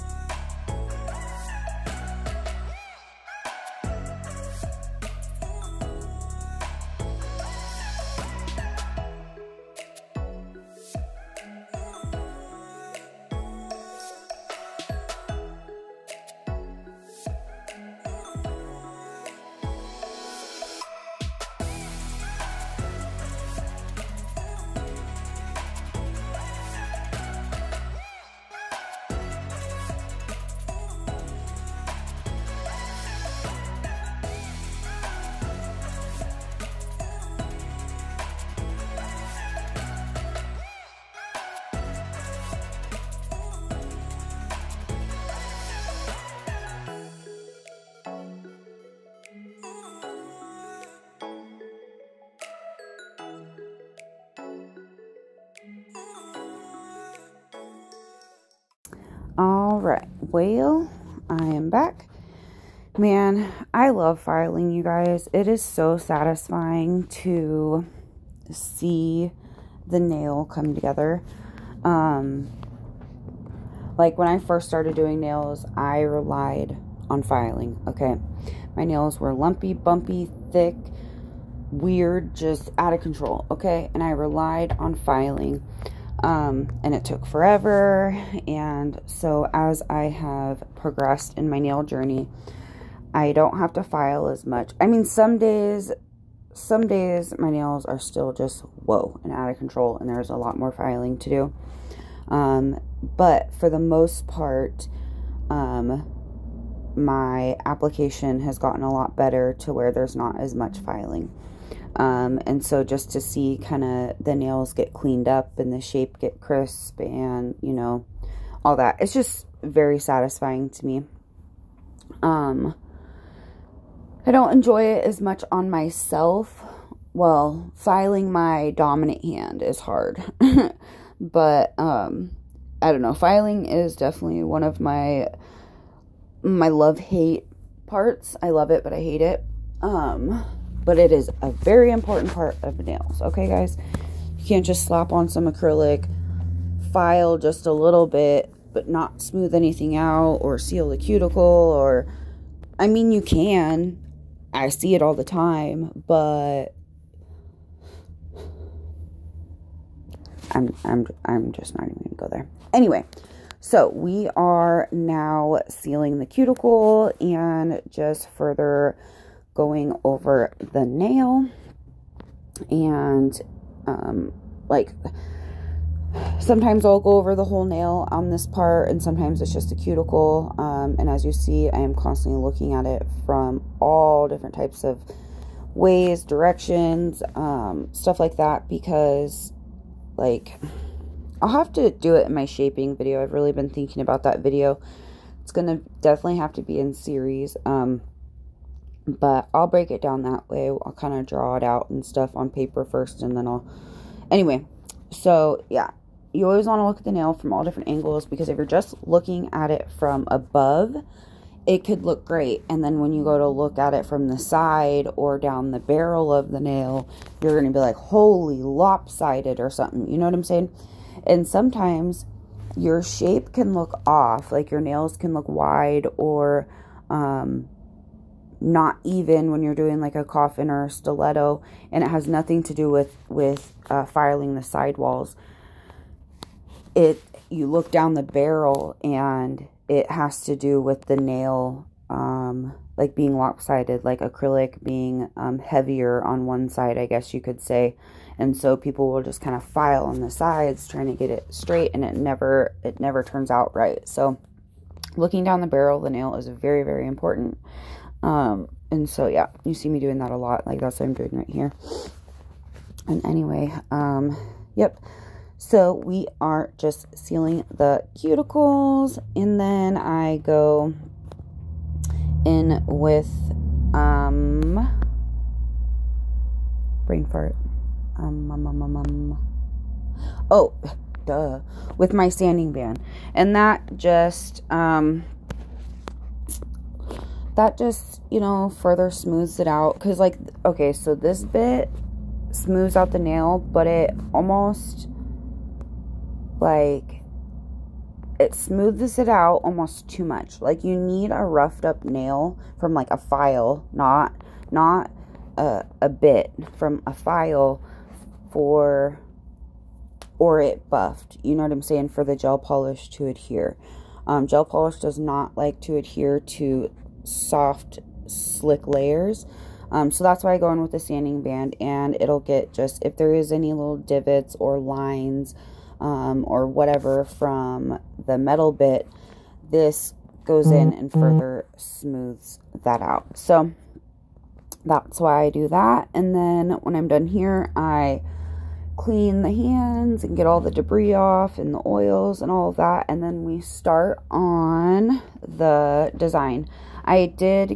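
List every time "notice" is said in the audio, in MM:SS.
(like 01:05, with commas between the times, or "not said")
not said.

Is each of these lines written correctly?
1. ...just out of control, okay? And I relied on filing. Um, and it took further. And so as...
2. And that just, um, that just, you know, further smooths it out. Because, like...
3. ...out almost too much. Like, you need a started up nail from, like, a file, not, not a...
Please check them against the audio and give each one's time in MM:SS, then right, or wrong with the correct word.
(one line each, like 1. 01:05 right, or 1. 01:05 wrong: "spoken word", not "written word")
1. 01:22 wrong: "forever", not "further"
2. 04:43 right
3. 04:59 wrong: "roughed", not "started".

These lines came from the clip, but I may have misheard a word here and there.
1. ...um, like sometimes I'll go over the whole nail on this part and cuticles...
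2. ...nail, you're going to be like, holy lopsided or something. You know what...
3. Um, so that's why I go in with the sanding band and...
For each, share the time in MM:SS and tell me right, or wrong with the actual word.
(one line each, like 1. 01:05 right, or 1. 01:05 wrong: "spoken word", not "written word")
1. 02:53 wrong: "sometimes", not "cuticles"
2. 03:36 right
3. 05:19 right.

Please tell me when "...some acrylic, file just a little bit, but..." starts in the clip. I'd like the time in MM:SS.
02:25.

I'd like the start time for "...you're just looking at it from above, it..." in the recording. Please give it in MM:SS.
03:28.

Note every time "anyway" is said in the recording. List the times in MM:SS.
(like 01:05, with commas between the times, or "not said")
02:42, 03:24, 04:23.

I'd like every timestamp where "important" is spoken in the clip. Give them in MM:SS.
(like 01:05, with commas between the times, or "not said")
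02:21, 04:17.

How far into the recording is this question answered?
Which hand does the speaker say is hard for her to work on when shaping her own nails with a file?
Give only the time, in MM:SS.
02:08.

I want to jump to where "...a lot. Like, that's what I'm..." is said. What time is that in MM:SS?
04:20.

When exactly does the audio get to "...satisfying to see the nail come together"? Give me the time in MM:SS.
01:05.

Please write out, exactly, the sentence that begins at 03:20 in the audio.
I'll kind of draw it out and stuff on paper first, and then I'll.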